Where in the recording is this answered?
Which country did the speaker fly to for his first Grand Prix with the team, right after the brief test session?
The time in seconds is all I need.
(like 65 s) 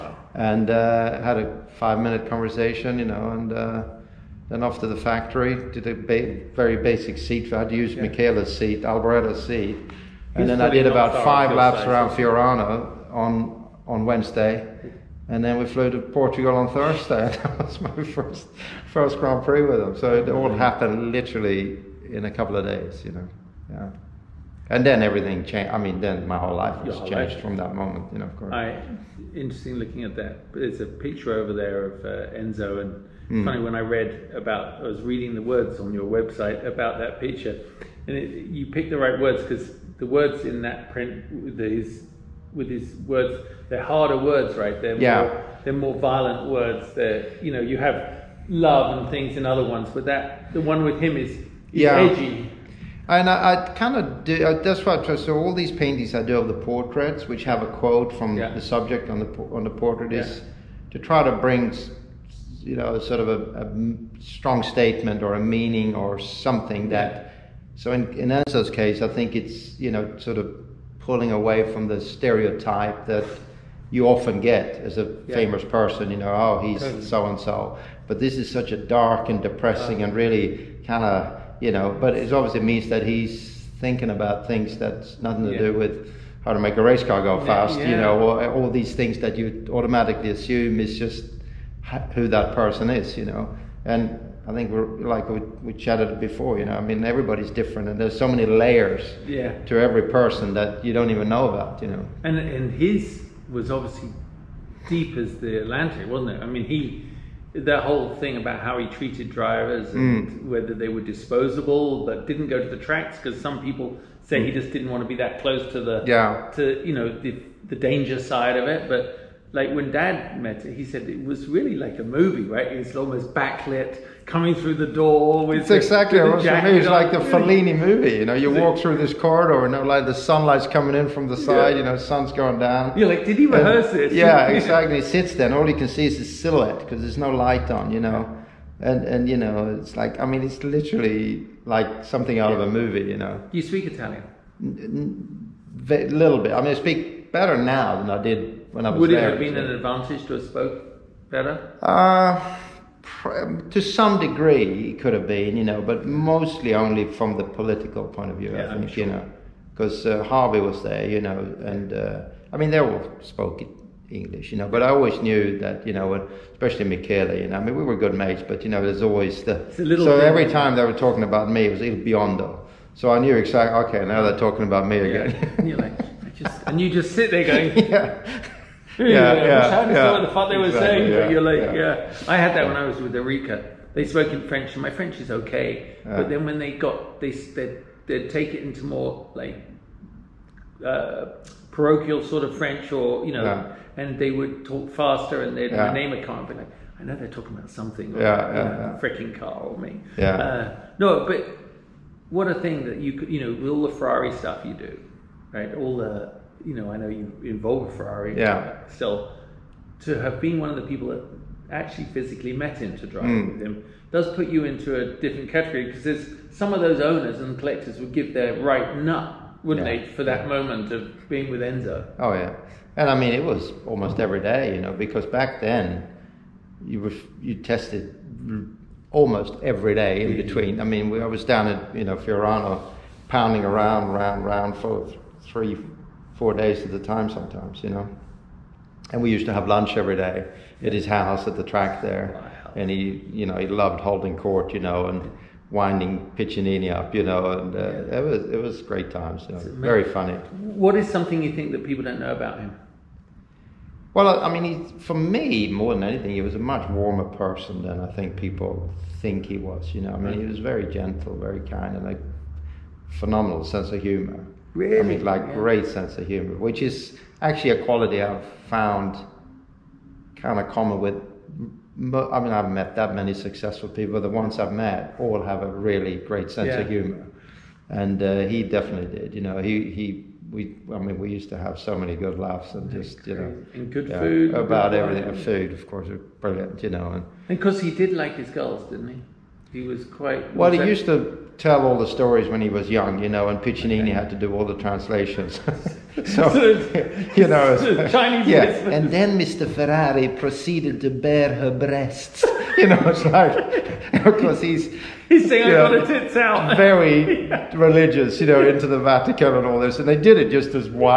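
15 s.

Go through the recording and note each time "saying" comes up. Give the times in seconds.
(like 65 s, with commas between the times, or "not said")
180 s, 305 s.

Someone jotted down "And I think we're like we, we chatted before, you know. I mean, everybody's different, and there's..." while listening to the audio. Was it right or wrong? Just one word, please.
right.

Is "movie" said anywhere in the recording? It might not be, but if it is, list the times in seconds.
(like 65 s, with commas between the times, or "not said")
122 s, 127 s, 142 s.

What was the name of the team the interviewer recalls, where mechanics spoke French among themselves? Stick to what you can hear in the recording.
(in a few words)
Oreca.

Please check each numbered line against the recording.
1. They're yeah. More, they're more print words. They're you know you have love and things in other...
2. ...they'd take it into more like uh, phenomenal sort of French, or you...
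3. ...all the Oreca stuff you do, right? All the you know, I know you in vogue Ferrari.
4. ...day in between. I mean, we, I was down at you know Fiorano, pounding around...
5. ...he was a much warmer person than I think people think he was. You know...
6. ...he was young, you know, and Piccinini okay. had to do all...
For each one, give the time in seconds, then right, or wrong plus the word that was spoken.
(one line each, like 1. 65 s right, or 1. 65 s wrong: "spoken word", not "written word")
1. 44 s wrong: "violent", not "print"
2. 188 s wrong: "parochial", not "phenomenal"
3. 203 s wrong: "Ferrari", not "Oreca"
4. 229 s right
5. 256 s right
6. 292 s right.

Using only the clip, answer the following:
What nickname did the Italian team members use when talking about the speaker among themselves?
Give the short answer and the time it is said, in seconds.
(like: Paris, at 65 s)
Il Biondo, at 171 s.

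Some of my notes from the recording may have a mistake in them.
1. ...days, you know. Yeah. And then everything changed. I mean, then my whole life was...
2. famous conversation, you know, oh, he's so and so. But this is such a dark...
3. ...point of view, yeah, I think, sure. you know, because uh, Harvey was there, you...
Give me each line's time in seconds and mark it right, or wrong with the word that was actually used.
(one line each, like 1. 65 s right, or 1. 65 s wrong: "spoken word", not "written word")
1. 22 s right
2. 75 s wrong: "person", not "conversation"
3. 158 s right.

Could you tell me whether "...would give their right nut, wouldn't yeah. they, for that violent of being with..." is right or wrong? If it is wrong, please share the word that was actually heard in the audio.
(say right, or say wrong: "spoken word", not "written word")
wrong: "moment", not "violent".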